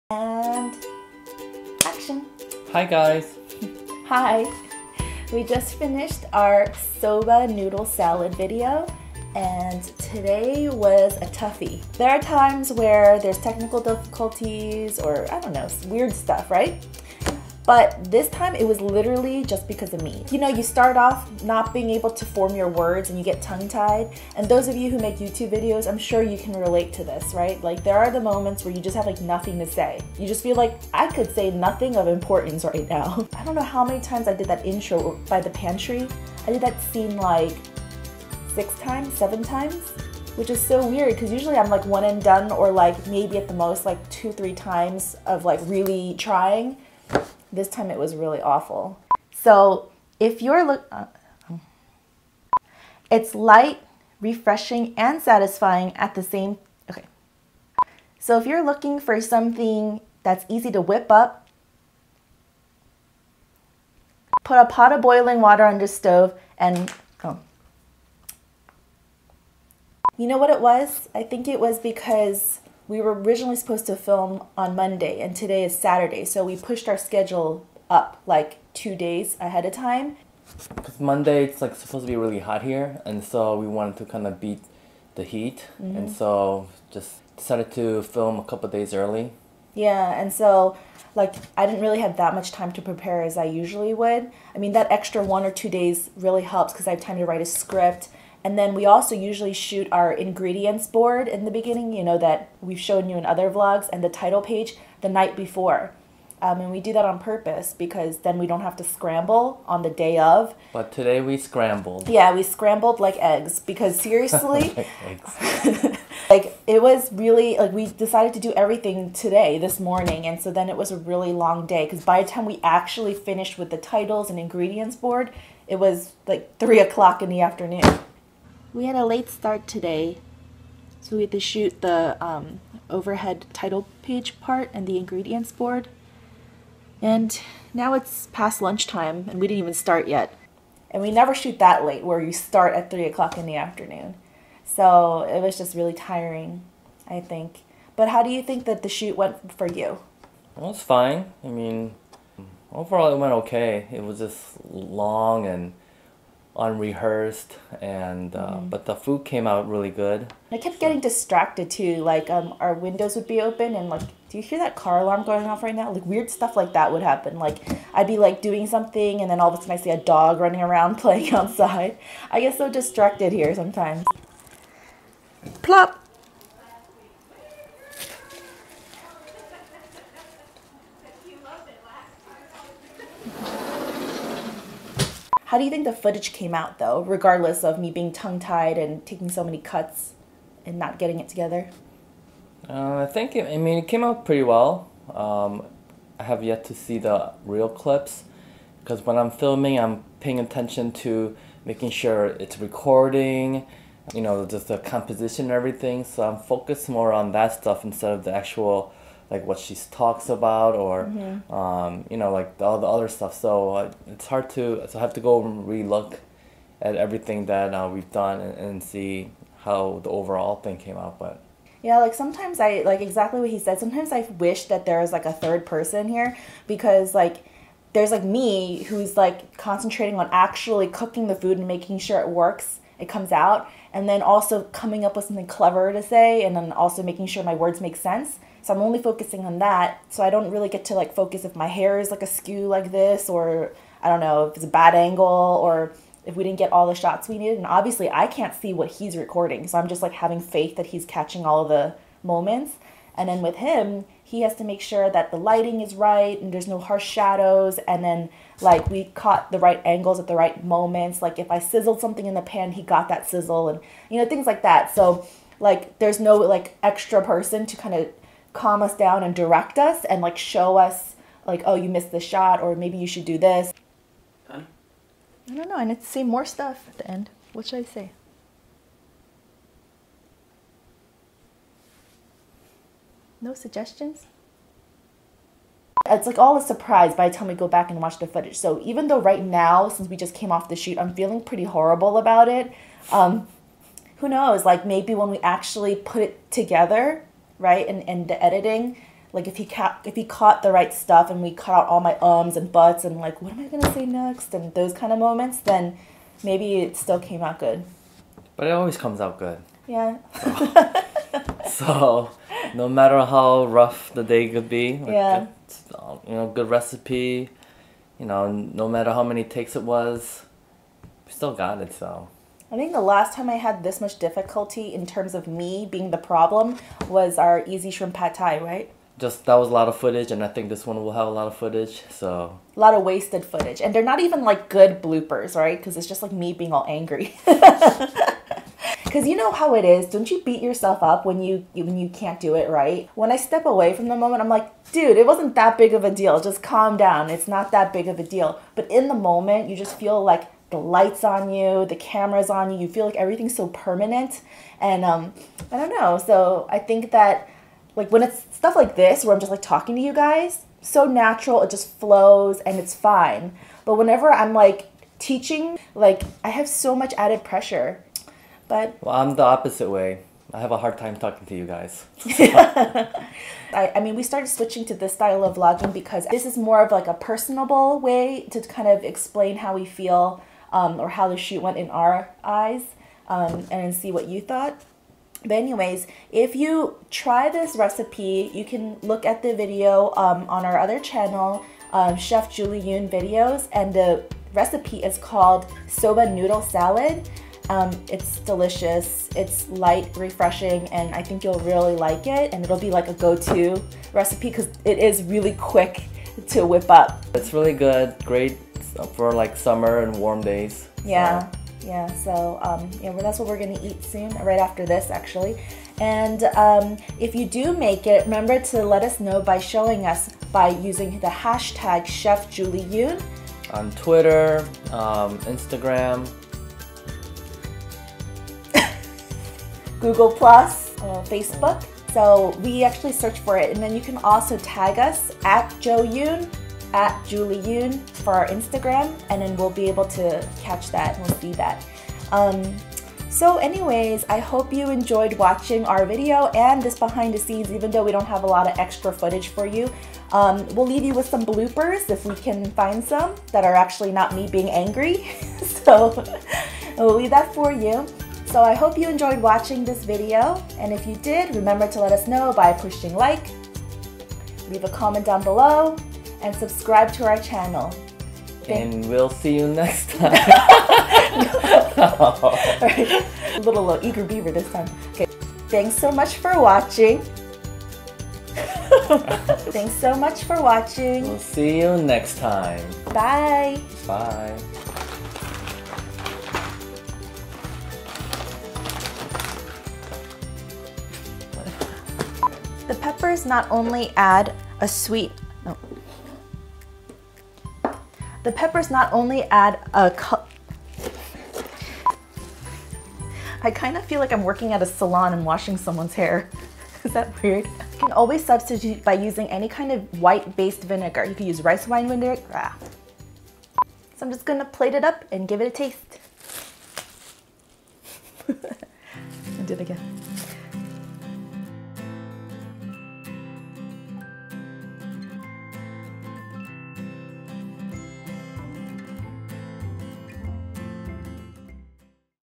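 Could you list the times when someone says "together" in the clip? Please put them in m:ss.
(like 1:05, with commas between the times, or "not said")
3:11, 4:56.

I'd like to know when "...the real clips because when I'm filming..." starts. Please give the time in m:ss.
3:16.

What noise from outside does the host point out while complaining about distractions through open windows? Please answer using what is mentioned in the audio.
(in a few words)
Car alarm.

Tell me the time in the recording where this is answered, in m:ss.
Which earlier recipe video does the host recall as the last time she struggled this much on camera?
5:27.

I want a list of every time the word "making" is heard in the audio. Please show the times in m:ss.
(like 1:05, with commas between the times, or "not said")
3:21, 3:51, 3:57.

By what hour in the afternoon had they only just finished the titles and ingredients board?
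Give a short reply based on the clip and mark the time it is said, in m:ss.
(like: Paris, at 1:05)
3 o'clock, at 2:06.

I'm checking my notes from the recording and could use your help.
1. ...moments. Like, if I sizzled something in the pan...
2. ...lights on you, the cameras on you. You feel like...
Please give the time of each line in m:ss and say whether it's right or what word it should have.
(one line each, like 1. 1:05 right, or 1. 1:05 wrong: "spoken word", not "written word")
1. 4:20 right
2. 5:50 right.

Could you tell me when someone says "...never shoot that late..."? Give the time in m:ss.
2:21.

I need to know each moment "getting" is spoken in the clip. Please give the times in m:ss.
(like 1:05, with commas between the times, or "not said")
2:40, 3:10.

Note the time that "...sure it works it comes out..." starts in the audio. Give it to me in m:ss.
3:51.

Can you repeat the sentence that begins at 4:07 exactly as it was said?
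And obviously I can't see what he's recording.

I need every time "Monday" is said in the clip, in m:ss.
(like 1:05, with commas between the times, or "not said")
1:14, 1:20.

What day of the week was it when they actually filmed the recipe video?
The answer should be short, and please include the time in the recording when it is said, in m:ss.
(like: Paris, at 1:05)
Saturday, at 1:15.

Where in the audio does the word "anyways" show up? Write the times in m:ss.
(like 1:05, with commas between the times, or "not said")
6:25, 7:23.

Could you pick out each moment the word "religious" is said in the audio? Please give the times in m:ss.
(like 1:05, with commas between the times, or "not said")
not said.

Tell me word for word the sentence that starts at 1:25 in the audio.
and so just decided to film a couple days early.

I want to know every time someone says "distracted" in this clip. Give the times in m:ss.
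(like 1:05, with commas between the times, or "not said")
2:40, 2:52.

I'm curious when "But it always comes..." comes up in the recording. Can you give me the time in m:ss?
5:08.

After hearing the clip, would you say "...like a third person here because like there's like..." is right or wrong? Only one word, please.
right.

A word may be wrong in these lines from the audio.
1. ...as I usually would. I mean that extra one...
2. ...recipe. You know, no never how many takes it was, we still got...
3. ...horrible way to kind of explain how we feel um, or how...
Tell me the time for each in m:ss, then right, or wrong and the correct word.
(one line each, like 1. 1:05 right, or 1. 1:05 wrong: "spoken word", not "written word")
1. 1:33 right
2. 5:16 wrong: "matter", not "never"
3. 6:17 wrong: "personable", not "horrible".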